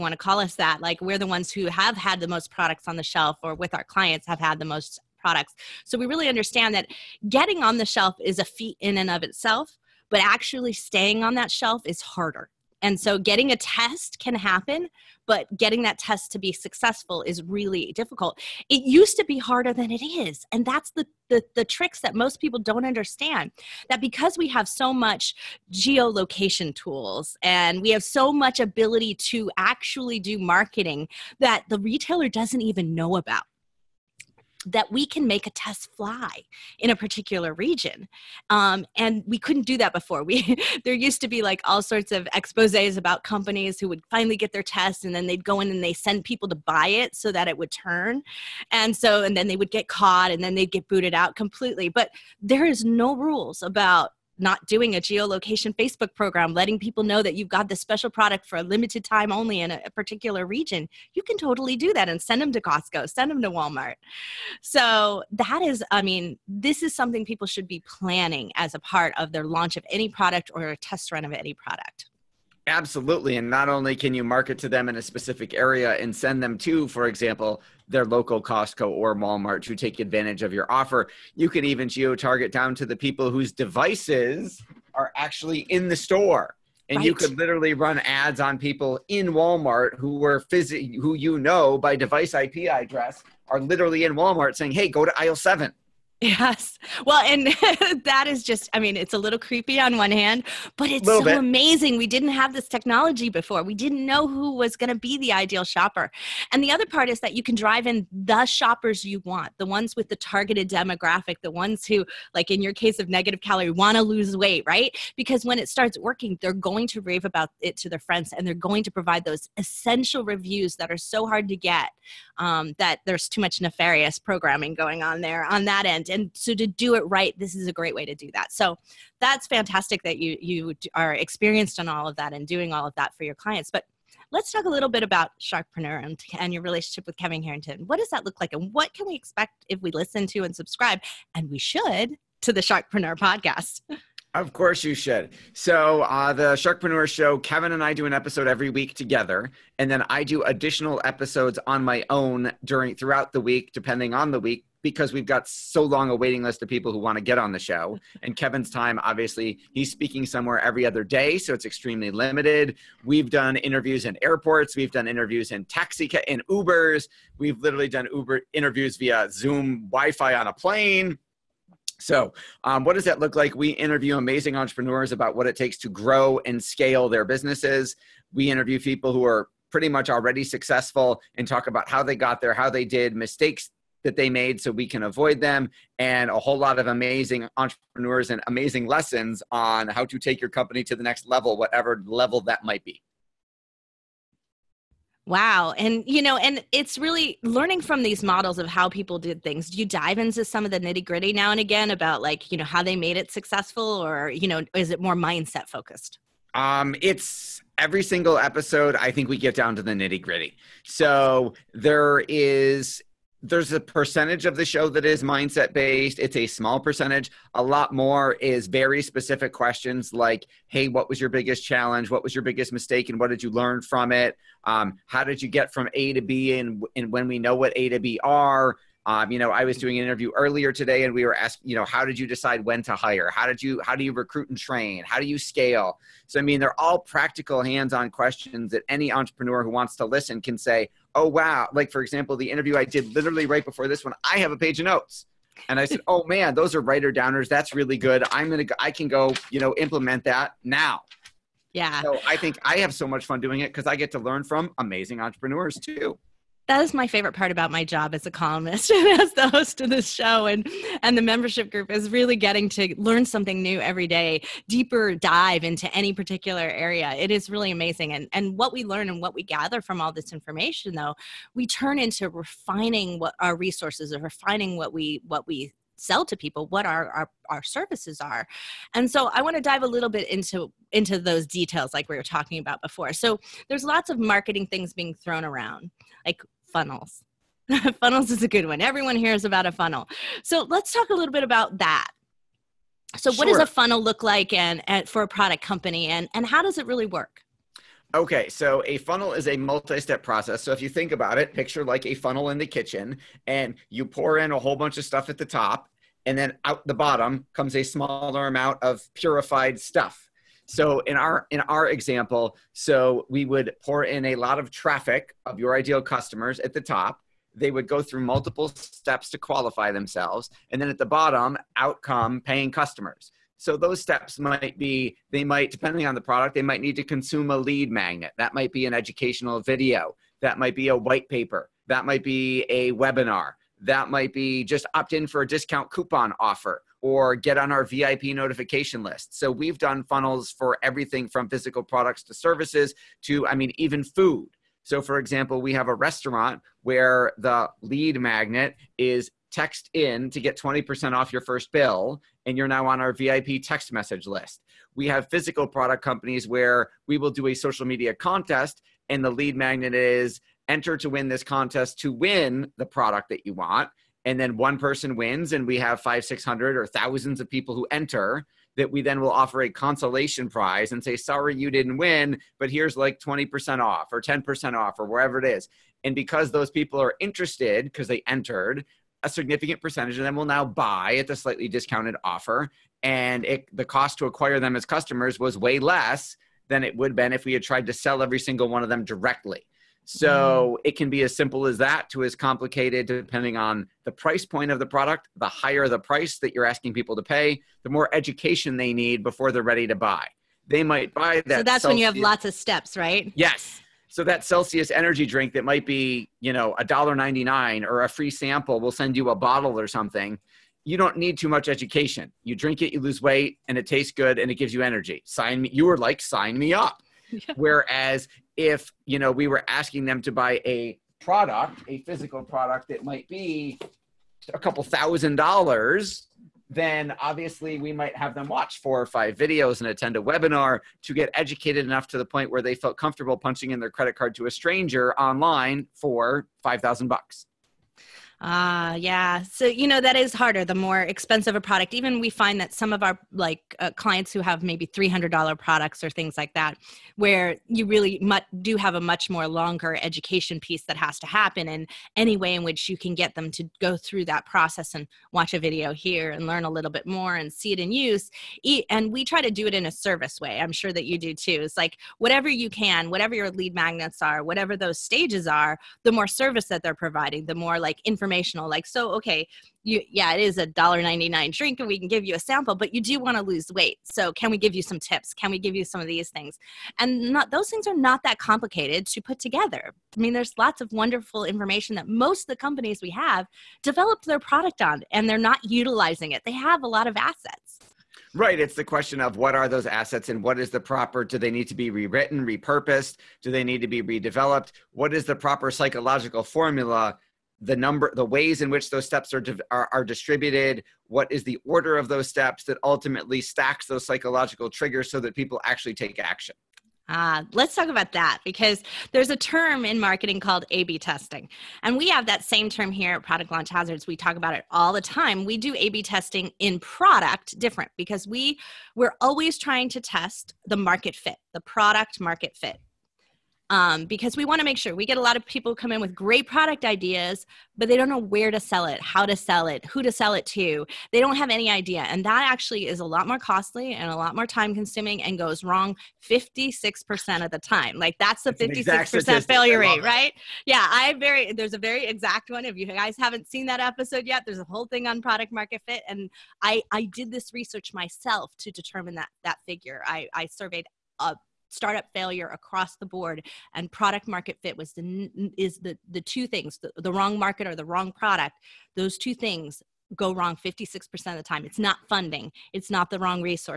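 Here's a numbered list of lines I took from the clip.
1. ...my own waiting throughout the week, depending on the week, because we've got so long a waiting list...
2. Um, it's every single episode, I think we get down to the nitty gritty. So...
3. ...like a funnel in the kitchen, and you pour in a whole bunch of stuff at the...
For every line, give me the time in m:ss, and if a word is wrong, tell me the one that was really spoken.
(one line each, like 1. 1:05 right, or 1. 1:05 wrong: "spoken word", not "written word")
1. 2:31 wrong: "during", not "waiting"
2. 3:26 right
3. 5:01 right.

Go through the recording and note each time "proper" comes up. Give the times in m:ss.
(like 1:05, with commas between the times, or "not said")
8:10, 8:15.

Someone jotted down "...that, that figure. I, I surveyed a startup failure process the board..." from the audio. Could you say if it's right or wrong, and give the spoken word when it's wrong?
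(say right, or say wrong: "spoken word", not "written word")
wrong: "across", not "process".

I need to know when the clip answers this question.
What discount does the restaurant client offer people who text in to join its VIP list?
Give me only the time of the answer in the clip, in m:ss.
5:50.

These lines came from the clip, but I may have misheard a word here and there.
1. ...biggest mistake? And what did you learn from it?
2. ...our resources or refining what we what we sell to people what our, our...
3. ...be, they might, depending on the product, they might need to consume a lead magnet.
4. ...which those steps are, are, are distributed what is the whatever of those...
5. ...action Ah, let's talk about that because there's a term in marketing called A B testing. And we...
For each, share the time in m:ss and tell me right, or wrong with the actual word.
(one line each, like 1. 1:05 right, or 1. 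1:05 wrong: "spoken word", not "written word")
1. 3:42 right
2. 4:33 right
3. 5:24 right
4. 8:18 wrong: "order", not "whatever"
5. 8:26 right.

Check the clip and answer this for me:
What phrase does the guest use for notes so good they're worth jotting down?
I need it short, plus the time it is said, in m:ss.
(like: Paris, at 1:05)
Writer downers, at 4:06.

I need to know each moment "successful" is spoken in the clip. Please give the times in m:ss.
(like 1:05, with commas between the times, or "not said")
0:16, 3:00, 3:23.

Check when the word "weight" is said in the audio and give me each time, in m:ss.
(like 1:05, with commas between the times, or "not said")
1:54, 6:53, 7:53.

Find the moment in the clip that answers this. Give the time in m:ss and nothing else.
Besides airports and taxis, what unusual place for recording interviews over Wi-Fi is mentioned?
2:50.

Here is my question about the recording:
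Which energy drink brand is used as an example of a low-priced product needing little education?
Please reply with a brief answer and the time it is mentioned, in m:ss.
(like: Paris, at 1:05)
Celsius, at 6:44.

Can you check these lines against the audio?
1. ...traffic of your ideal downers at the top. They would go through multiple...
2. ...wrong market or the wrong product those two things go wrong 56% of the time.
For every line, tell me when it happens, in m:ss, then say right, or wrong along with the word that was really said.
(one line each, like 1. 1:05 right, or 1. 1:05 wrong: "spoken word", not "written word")
1. 5:14 wrong: "customers", not "downers"
2. 9:17 right.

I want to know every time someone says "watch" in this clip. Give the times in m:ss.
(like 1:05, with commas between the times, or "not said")
7:08, 7:35.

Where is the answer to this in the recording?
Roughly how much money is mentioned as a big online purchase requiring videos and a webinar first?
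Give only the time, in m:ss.
7:16.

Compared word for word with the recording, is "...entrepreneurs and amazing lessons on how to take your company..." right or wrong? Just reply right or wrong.
right.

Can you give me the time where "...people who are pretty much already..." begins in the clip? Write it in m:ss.
2:58.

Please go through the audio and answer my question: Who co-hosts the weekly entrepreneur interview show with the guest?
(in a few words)
Kevin Harrington.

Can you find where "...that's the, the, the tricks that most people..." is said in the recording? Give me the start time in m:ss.
0:20.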